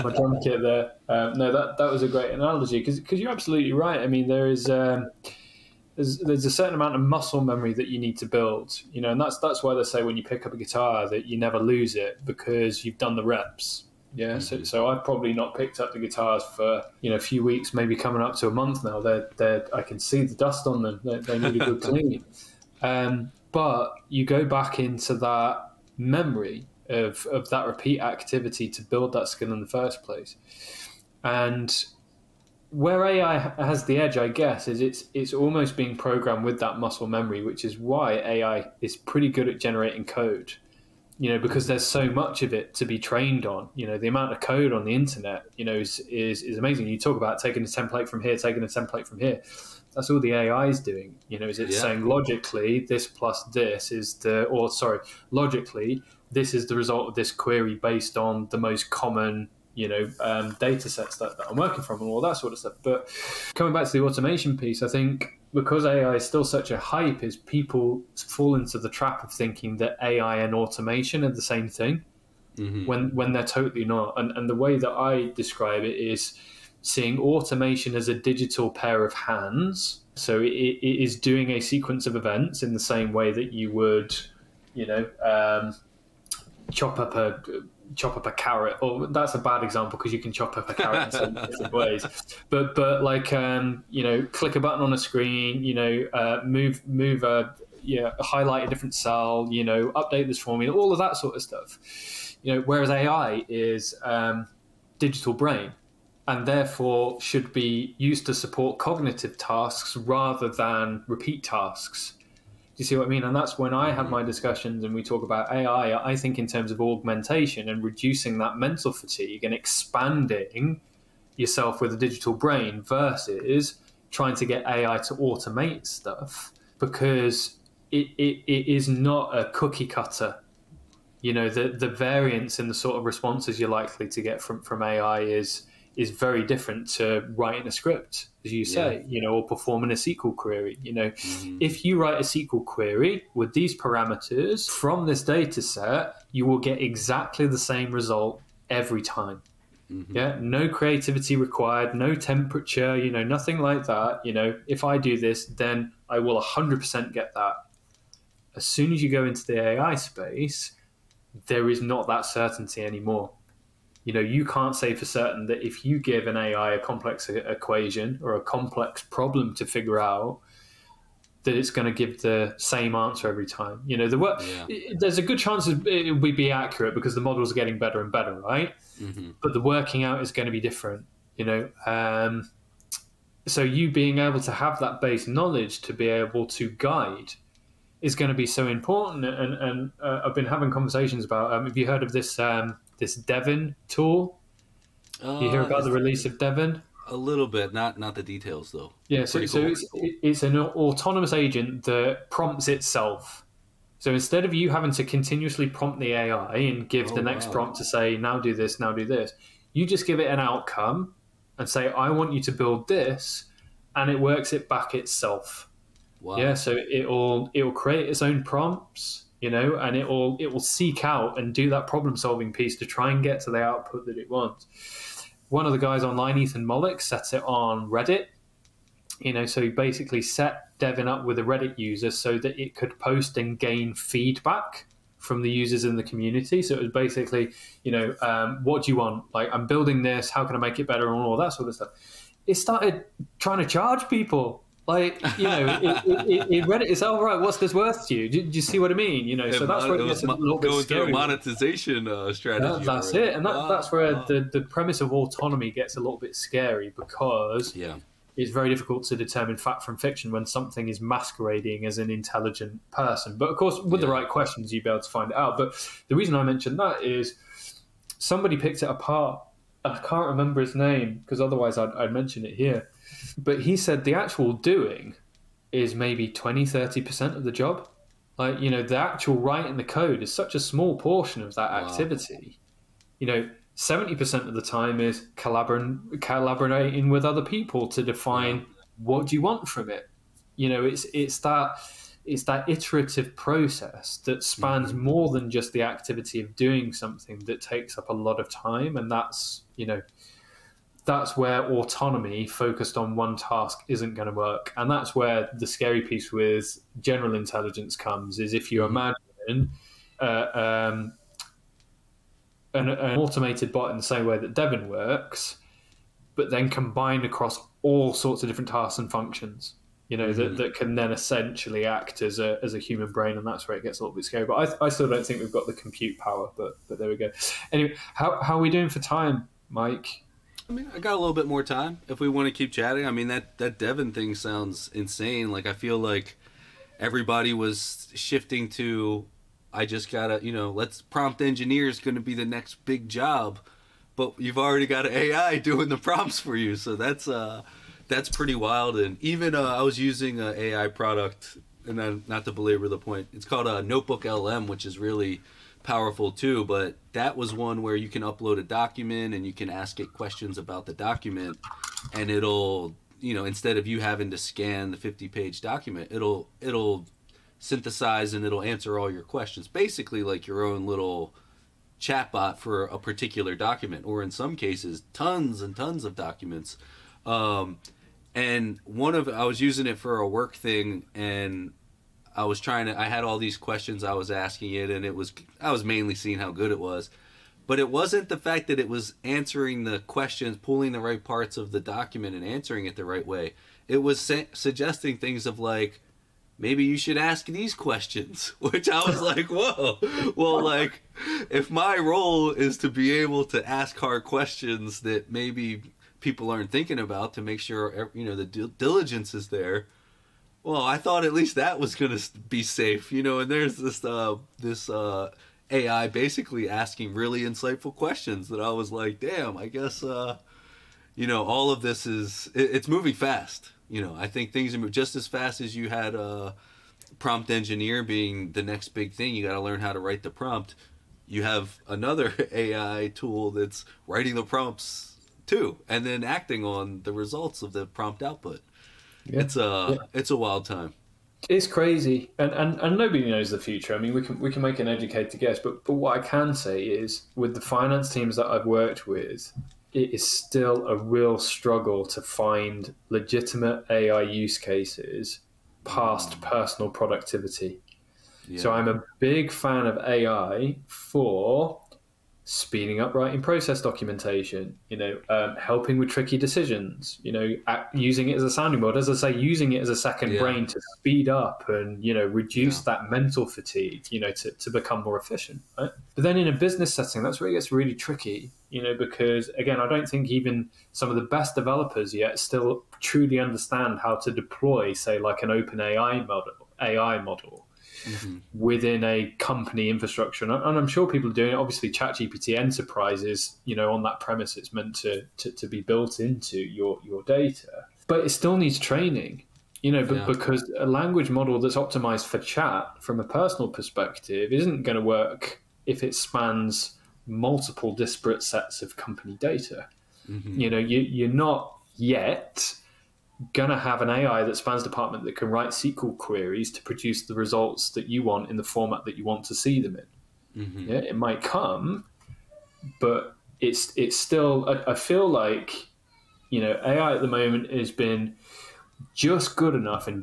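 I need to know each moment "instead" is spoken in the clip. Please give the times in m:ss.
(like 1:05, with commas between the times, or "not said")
3:24, 6:03.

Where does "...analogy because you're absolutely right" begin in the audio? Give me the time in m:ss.
0:02.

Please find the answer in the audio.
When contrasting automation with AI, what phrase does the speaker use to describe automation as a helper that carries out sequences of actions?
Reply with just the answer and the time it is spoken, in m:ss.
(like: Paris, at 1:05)
Digital pair of hands, at 1:18.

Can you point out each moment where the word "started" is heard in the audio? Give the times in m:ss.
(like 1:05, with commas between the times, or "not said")
4:02.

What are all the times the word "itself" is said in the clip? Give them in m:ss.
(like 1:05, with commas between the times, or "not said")
3:22, 3:34.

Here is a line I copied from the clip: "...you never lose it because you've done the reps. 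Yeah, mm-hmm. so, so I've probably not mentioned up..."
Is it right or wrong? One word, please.
wrong.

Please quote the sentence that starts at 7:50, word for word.
brain to speed up and, you know, reduce yeah.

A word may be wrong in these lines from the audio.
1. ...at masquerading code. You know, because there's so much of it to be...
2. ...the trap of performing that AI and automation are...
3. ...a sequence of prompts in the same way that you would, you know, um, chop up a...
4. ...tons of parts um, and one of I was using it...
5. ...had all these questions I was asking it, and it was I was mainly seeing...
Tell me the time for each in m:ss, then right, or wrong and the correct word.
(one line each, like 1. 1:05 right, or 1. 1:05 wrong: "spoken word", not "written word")
1. 0:39 wrong: "generating", not "masquerading"
2. 1:08 wrong: "thinking", not "performing"
3. 1:21 wrong: "events", not "prompts"
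4. 6:15 wrong: "documents", not "parts"
5. 6:23 right.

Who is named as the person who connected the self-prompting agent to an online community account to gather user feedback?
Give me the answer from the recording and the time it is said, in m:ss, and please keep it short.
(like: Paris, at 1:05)
Ethan Mollick, at 3:46.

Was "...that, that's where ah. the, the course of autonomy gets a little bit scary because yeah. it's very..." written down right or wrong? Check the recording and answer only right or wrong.
wrong.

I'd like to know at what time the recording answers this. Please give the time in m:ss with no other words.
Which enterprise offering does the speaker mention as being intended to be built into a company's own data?
8:11.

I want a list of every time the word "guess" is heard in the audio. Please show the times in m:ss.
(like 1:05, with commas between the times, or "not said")
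0:34, 6:59, 7:25.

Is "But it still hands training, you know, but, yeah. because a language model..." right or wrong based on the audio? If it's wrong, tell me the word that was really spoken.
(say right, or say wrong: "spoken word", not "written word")
wrong: "needs", not "hands".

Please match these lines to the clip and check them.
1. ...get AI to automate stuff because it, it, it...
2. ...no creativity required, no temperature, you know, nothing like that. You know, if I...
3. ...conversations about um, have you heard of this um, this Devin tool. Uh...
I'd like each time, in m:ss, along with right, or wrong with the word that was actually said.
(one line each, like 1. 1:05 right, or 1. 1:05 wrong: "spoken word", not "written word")
1. 2:04 right
2. 2:30 right
3. 3:10 right.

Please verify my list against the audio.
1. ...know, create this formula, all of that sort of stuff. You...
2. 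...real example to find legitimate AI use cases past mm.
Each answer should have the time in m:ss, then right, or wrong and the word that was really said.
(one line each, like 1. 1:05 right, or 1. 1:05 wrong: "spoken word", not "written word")
1. 1:39 wrong: "update", not "create"
2. 7:30 wrong: "struggle", not "example".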